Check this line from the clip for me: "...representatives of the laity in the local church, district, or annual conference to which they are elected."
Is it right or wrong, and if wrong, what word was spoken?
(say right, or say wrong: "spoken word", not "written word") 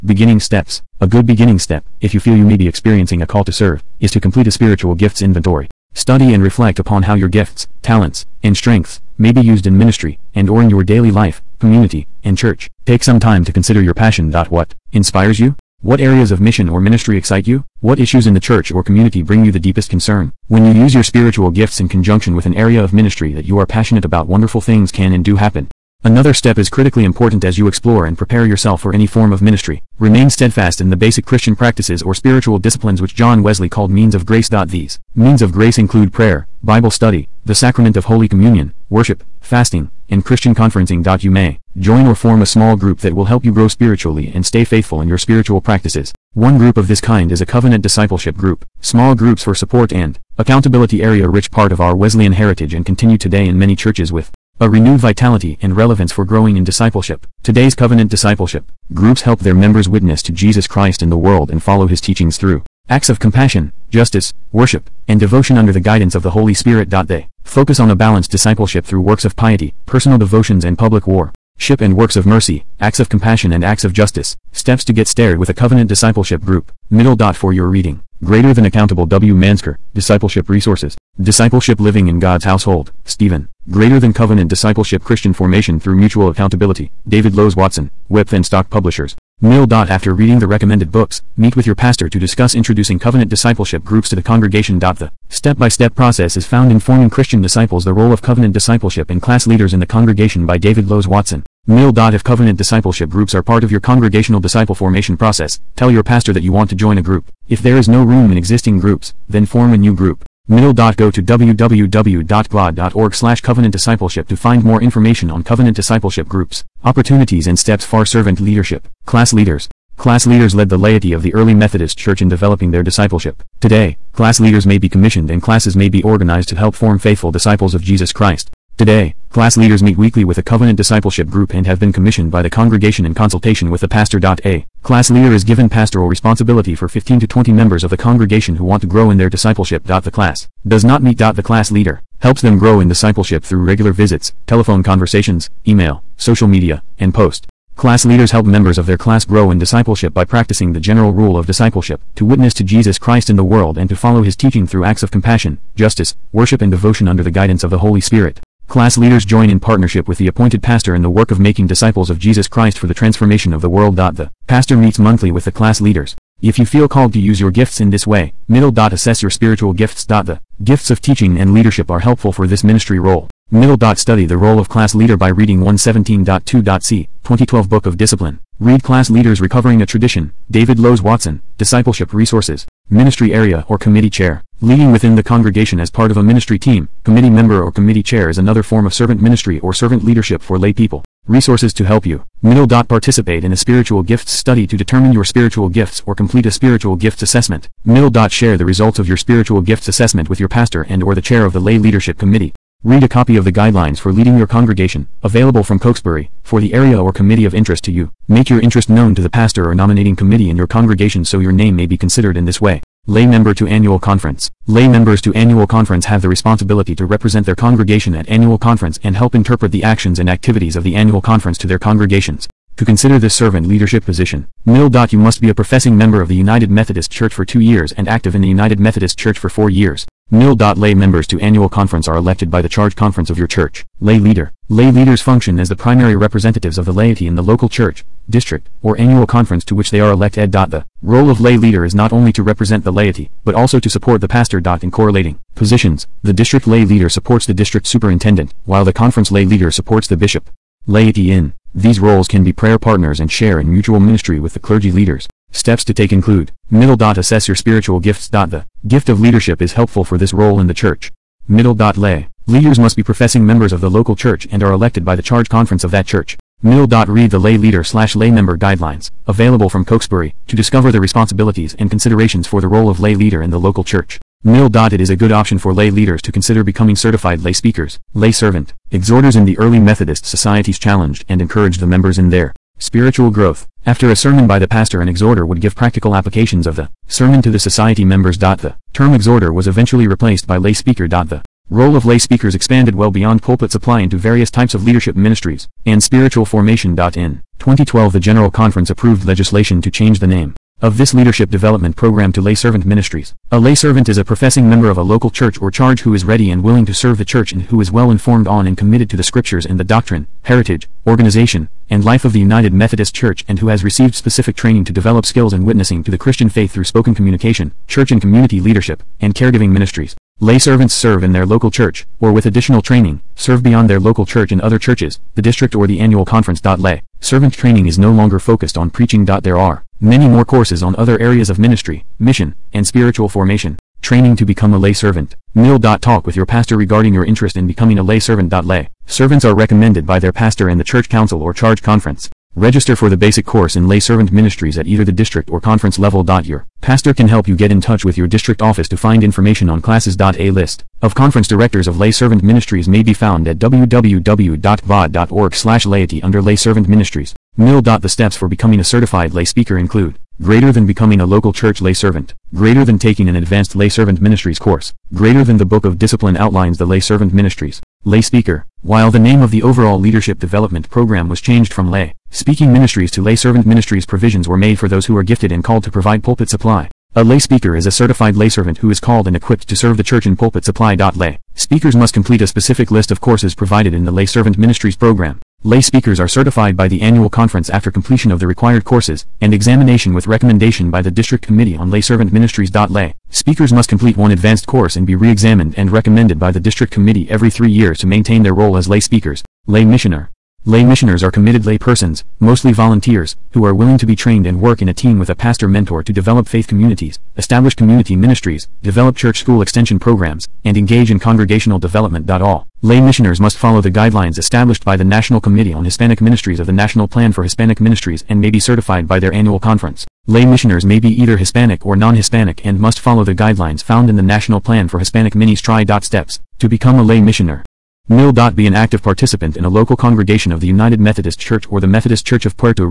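right.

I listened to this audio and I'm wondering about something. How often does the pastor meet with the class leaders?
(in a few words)
monthly.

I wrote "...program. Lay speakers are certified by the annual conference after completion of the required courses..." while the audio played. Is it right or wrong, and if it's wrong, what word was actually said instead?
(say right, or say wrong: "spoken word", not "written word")
right.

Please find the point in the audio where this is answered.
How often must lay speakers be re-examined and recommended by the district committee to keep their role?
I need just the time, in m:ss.
6:37.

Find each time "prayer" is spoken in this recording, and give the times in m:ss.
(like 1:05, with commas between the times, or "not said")
0:36, 4:12.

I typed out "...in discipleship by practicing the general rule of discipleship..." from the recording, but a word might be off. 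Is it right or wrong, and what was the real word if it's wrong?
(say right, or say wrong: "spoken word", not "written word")
right.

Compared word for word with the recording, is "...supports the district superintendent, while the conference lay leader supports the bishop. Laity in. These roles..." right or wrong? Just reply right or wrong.
right.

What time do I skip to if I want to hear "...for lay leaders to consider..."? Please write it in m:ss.
4:35.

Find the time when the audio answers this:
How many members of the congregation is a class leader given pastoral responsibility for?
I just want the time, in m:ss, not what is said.
2:16.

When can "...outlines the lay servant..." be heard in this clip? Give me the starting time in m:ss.
6:06.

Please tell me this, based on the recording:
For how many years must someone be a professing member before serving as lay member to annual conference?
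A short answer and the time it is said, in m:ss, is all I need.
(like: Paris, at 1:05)
2, at 3:47.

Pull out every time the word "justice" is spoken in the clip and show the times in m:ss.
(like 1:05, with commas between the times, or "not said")
1:03, 1:13, 2:35.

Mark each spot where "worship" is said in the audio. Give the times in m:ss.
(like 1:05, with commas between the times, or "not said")
0:38, 1:04, 2:36.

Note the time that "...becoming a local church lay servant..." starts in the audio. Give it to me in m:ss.
6:00.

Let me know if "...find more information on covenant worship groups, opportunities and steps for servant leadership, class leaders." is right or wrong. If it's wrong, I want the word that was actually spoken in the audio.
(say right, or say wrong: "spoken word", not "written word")
wrong: "discipleship", not "worship".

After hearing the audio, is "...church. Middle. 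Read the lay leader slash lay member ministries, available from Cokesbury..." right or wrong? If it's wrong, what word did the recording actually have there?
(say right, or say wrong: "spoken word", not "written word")
wrong: "guidelines", not "ministries".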